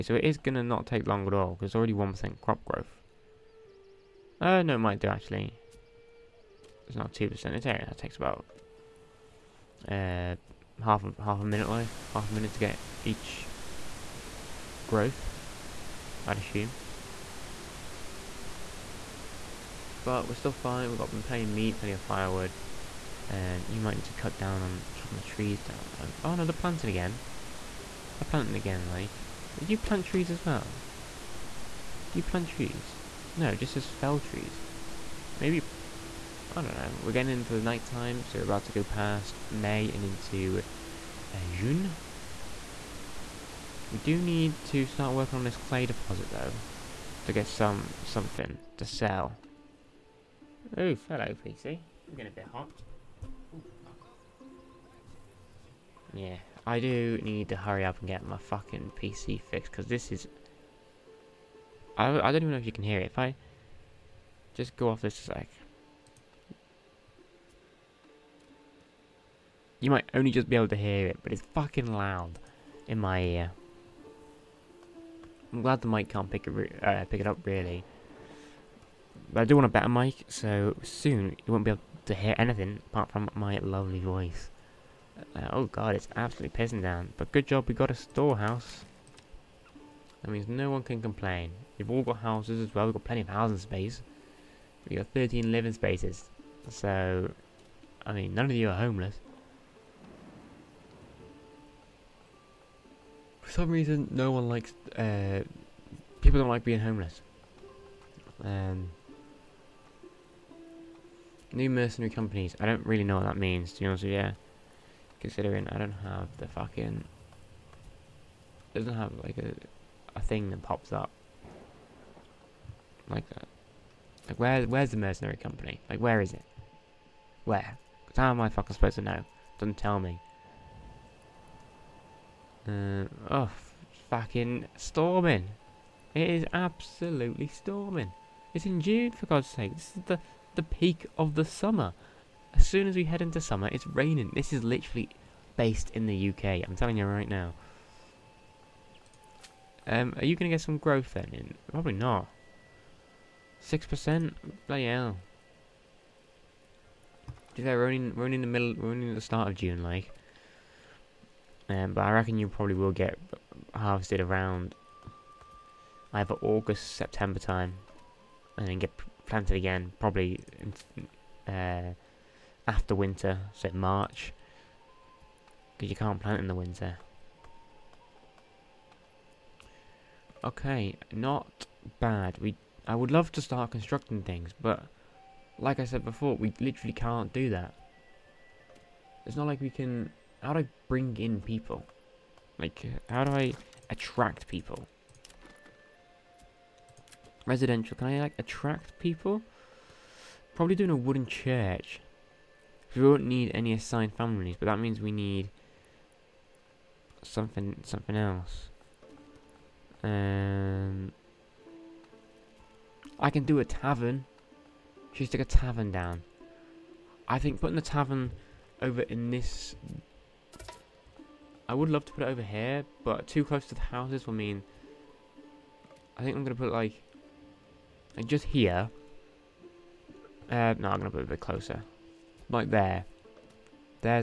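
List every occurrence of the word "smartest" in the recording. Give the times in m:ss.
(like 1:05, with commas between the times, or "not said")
not said.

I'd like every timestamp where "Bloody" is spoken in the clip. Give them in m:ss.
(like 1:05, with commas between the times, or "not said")
2:34.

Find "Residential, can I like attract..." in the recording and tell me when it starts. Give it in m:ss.
3:17.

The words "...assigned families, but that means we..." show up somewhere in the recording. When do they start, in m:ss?
3:23.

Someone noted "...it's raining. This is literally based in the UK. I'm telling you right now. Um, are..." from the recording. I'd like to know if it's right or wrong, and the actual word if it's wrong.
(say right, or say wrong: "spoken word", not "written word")
right.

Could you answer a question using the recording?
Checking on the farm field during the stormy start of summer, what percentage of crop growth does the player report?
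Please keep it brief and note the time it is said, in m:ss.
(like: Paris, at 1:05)
6%, at 2:33.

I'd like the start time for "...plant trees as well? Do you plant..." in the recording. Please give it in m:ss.
0:29.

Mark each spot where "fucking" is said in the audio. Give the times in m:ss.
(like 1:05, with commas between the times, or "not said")
0:58, 1:11, 1:56, 2:08, 2:14.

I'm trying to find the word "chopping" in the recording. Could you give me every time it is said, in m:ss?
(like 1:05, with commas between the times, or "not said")
0:24.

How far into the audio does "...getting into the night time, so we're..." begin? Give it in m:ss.
0:37.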